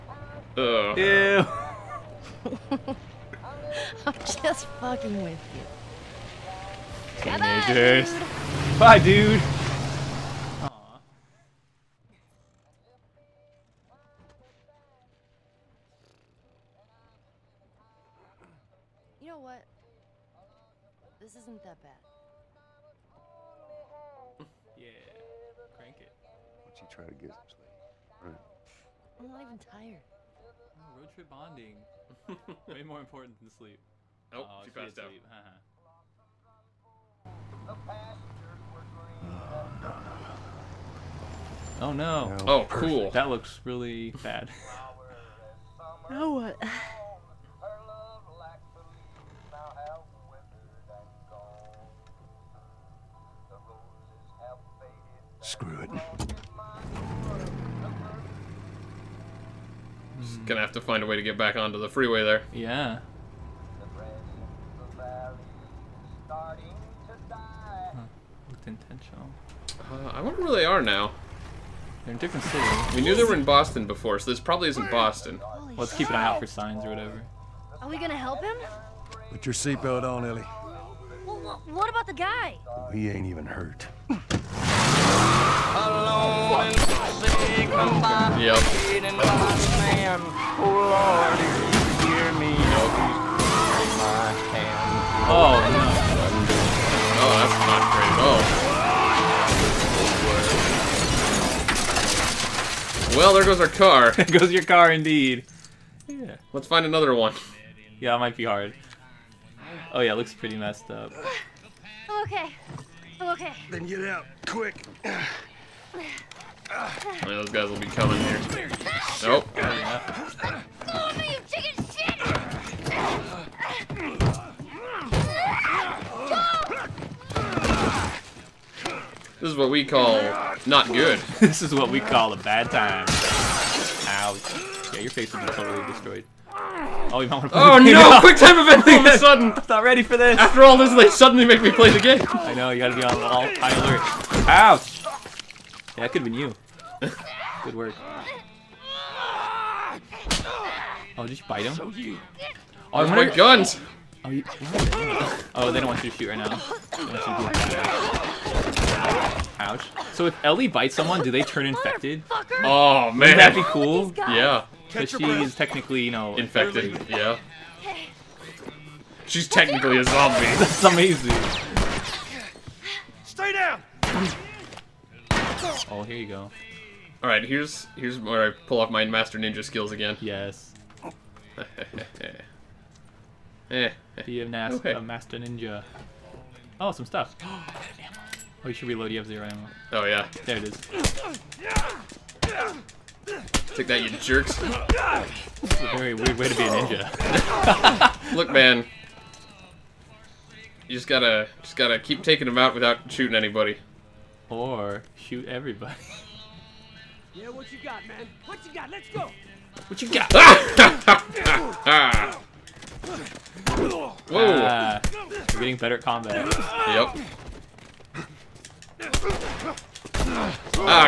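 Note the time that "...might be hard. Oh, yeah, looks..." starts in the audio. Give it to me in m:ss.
1:48.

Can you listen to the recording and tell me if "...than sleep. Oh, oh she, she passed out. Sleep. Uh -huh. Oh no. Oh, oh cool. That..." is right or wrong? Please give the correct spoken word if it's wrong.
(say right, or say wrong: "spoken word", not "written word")
right.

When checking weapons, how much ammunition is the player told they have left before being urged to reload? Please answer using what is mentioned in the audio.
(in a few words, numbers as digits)
0.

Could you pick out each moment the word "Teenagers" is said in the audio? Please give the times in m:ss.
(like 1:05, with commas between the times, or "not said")
0:07.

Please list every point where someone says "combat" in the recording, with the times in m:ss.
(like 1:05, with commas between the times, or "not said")
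3:36.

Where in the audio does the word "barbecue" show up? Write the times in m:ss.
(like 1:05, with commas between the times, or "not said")
not said.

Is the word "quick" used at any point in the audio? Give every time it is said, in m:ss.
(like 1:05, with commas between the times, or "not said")
1:54, 2:18.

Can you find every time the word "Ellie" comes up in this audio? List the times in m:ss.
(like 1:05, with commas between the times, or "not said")
1:20, 2:40.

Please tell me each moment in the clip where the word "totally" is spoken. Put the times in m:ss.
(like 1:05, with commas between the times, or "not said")
2:15.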